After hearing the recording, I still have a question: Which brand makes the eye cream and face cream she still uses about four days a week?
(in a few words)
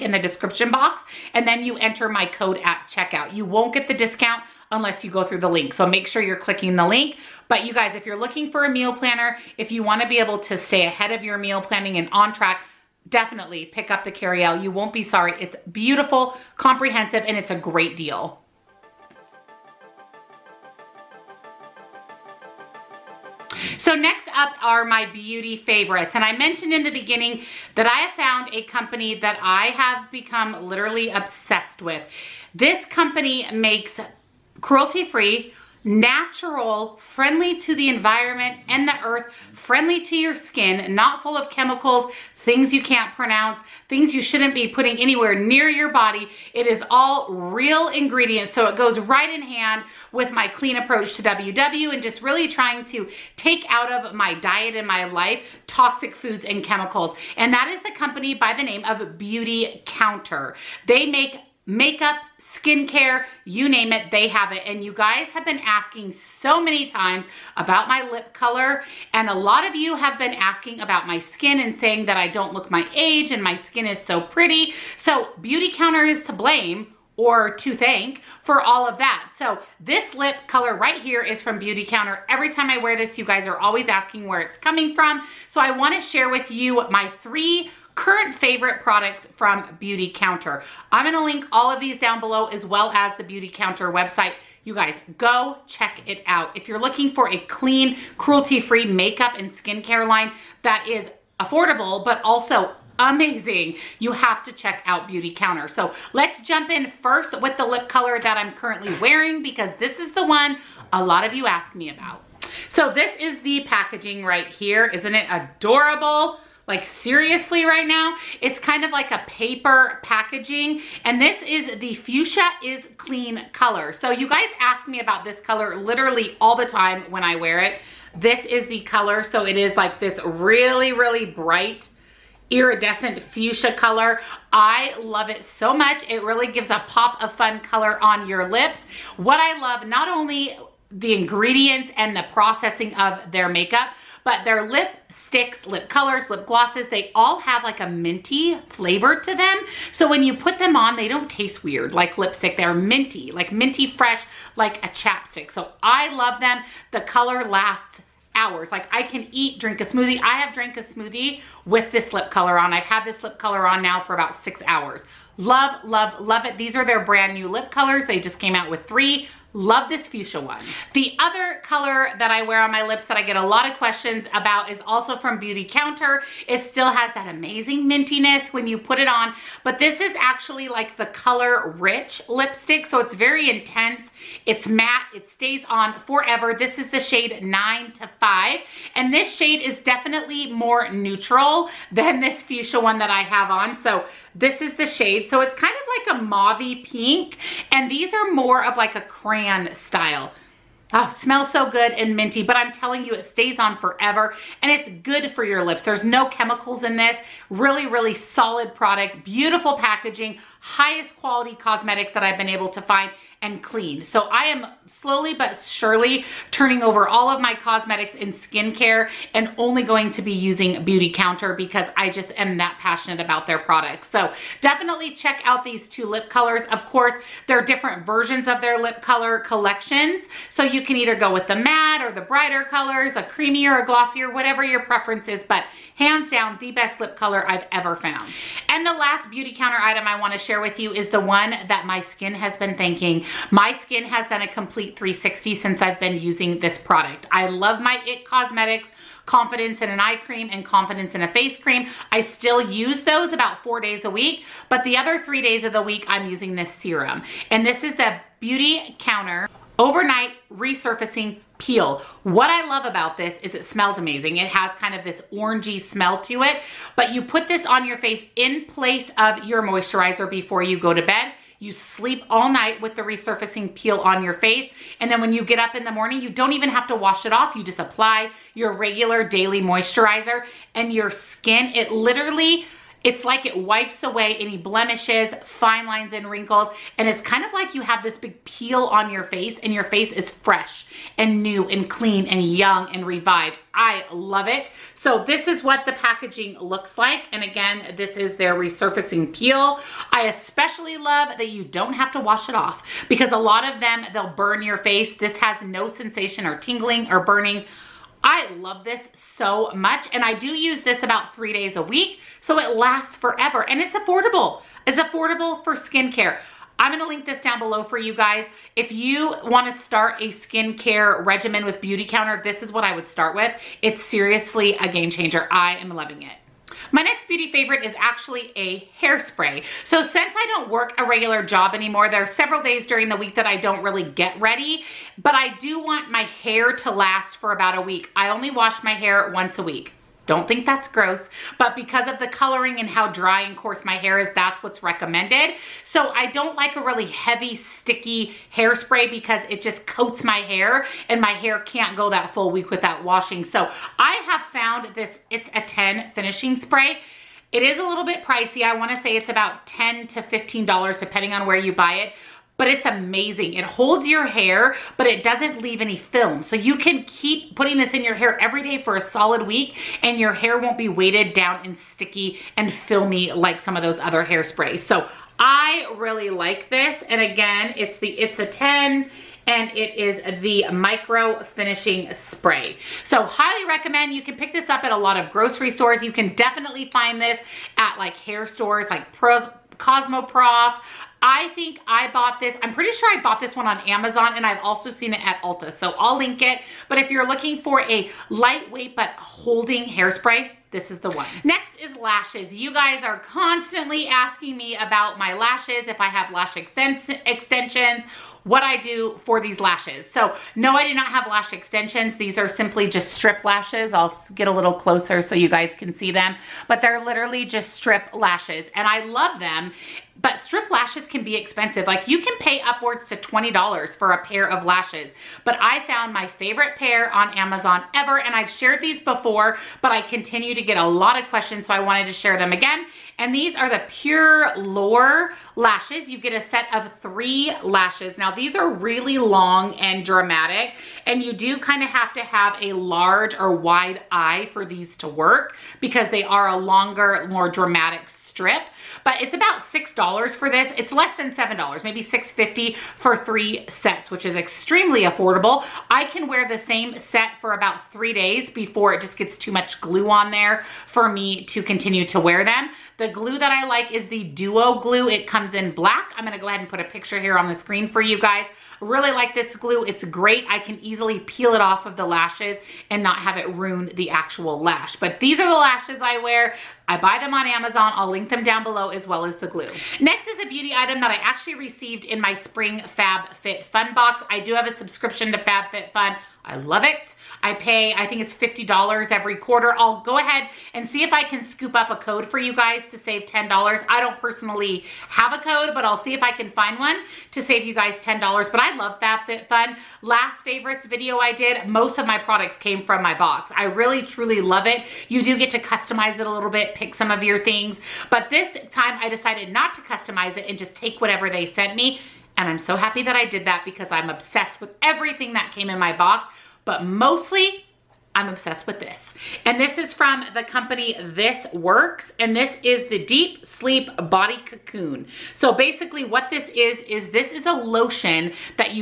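IT Cosmetics.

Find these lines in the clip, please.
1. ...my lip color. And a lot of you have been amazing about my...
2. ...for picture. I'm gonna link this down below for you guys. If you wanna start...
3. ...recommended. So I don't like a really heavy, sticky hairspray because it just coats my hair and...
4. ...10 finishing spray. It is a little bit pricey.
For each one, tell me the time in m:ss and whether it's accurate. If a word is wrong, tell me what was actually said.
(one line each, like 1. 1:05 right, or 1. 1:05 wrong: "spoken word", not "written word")
1. 1:07 wrong: "asking", not "amazing"
2. 5:15 wrong: "skincare", not "picture"
3. 5:44 right
4. 5:55 right.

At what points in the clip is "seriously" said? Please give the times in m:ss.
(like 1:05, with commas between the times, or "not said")
1:57, 5:24.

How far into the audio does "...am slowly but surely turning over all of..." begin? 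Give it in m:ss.
3:34.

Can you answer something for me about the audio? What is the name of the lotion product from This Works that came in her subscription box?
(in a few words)
Deep Sleep Body Cocoon.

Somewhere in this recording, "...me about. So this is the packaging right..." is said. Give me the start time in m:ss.
1:51.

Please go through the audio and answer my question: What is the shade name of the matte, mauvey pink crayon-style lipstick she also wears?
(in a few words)
9 to 5.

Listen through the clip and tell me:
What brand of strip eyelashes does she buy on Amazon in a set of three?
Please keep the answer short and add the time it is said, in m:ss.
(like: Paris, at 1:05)
Pure Lore, at 7:13.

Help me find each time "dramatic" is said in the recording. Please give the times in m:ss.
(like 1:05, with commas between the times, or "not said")
7:20, 7:27.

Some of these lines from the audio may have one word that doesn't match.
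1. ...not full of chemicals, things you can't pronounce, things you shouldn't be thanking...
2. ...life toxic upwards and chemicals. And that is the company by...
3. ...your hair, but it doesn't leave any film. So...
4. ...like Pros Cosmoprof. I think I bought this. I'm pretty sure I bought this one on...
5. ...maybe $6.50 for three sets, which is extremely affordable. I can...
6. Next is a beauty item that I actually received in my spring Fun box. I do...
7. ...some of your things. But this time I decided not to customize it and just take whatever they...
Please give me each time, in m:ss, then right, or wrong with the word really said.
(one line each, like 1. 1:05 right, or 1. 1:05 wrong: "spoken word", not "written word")
1. 0:40 wrong: "putting", not "thanking"
2. 0:55 wrong: "foods", not "upwards"
3. 6:04 right
4. 6:28 right
5. 7:31 right
6. 8:00 right
7. 8:26 right.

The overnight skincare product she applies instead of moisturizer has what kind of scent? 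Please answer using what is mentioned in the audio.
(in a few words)
orangey.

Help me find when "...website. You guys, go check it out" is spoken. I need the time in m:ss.
1:33.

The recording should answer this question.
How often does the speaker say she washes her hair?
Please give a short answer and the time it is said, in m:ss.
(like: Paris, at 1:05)
once a week, at 5:39.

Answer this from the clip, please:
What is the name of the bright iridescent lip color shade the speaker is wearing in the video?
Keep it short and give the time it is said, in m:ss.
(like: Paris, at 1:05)
Fuchsia is Clean, at 2:01.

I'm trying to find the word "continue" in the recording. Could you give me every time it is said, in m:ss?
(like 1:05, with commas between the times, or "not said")
7:10, 7:41.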